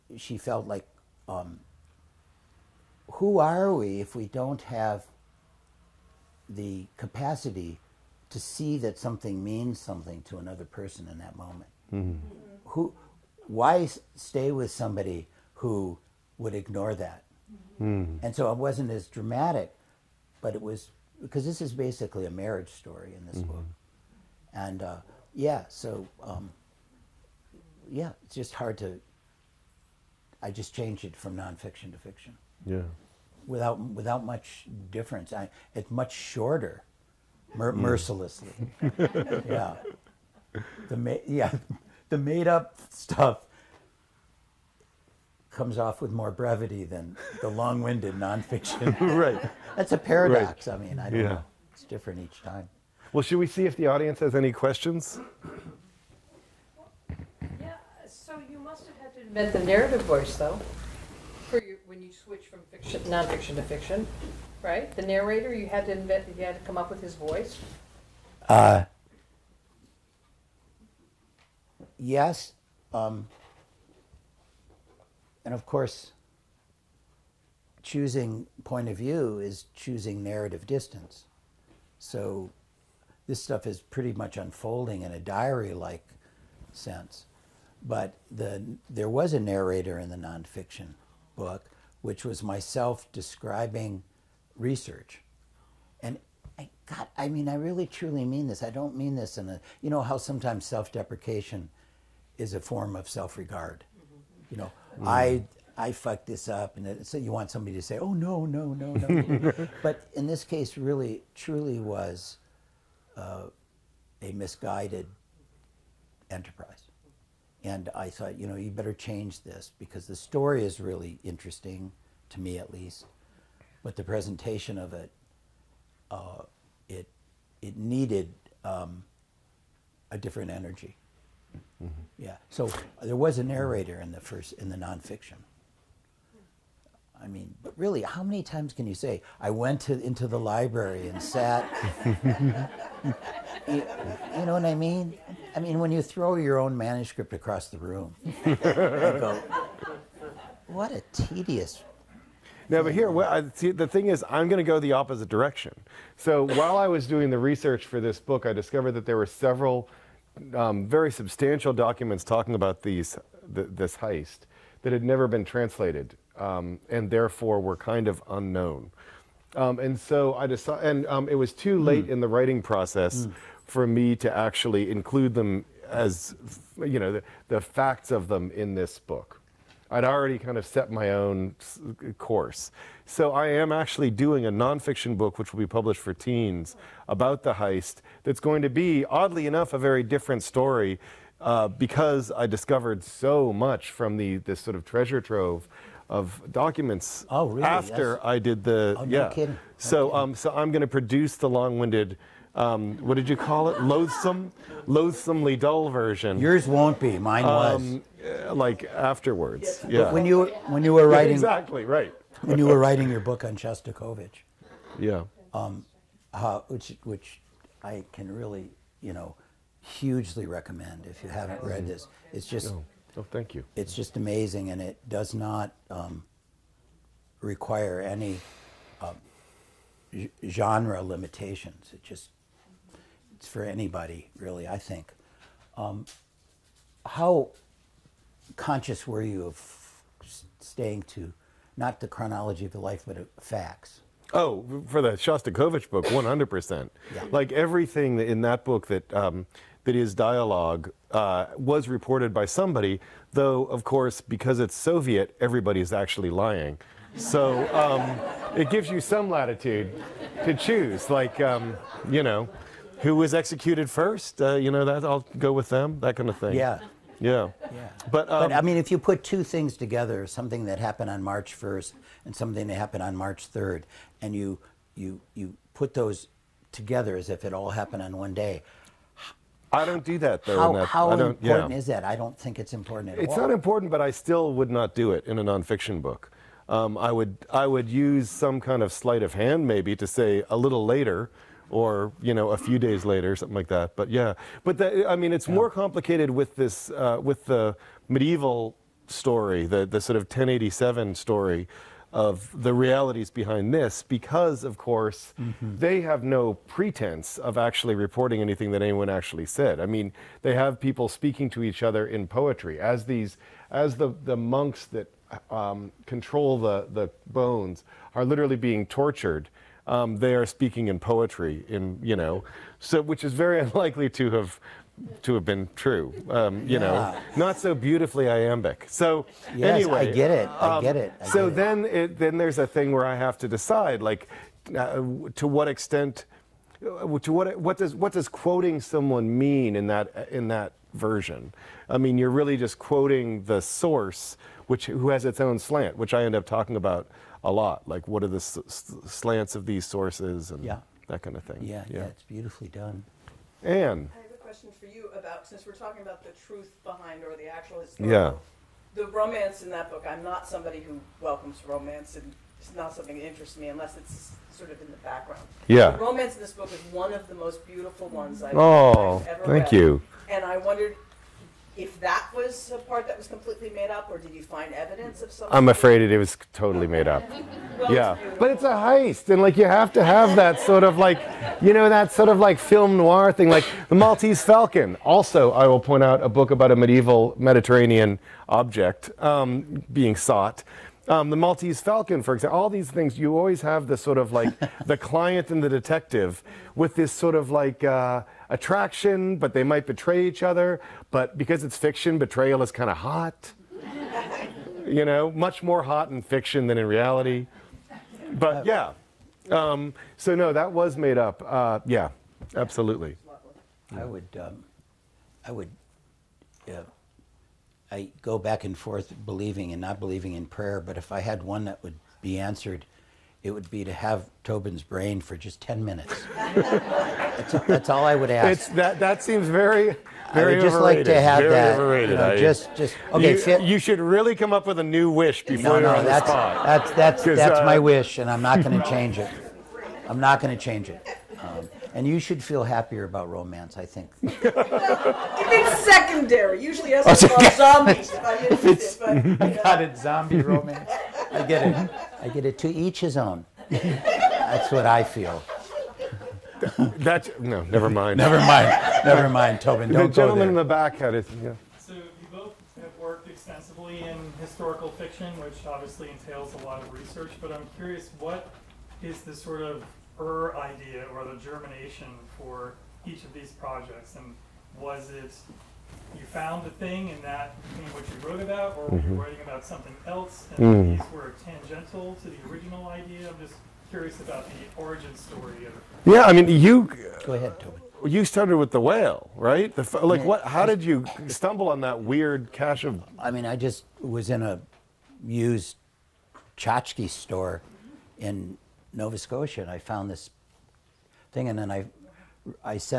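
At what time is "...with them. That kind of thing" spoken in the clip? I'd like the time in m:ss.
4:25.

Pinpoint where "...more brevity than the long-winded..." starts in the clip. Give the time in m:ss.
0:46.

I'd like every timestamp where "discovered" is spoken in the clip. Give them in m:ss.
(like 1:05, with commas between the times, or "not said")
2:38, 3:12.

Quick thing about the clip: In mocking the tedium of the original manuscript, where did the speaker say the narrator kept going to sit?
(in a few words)
the library.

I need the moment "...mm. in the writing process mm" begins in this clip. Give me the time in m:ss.
2:52.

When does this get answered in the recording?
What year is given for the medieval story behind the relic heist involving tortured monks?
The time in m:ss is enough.
5:00.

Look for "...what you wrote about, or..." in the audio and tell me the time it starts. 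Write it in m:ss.
7:57.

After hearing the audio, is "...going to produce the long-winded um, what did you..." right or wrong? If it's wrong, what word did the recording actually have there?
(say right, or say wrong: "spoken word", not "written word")
right.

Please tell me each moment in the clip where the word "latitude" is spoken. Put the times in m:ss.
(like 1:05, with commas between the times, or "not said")
4:19.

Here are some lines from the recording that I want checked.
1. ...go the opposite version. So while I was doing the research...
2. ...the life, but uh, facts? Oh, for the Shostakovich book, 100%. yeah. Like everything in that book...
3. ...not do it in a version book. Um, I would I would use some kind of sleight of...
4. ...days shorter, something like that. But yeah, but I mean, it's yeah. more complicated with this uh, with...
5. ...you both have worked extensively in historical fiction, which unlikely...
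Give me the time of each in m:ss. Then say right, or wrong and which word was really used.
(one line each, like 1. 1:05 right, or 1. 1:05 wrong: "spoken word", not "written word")
1. 2:34 wrong: "direction", not "version"
2. 4:02 right
3. 4:44 wrong: "nonfiction", not "version"
4. 4:52 wrong: "later", not "shorter"
5. 7:41 wrong: "obviously", not "unlikely".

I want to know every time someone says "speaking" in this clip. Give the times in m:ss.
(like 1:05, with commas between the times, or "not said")
5:11, 5:20.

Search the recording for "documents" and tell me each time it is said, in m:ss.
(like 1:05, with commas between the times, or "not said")
2:41, 3:16.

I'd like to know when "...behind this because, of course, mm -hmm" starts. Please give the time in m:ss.
5:03.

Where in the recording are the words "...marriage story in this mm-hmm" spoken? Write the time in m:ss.
0:22.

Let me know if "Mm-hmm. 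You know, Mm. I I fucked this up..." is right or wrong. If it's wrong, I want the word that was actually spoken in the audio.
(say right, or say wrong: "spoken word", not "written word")
right.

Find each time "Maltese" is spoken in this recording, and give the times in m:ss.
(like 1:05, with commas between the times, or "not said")
6:23, 6:31.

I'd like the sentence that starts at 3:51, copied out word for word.
It just it's for anybody really, I think.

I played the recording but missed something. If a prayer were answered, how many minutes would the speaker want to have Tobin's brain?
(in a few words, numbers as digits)
10.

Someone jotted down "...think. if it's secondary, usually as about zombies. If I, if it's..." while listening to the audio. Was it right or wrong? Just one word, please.
right.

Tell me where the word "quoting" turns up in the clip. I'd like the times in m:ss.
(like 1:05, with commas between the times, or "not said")
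5:38, 5:42.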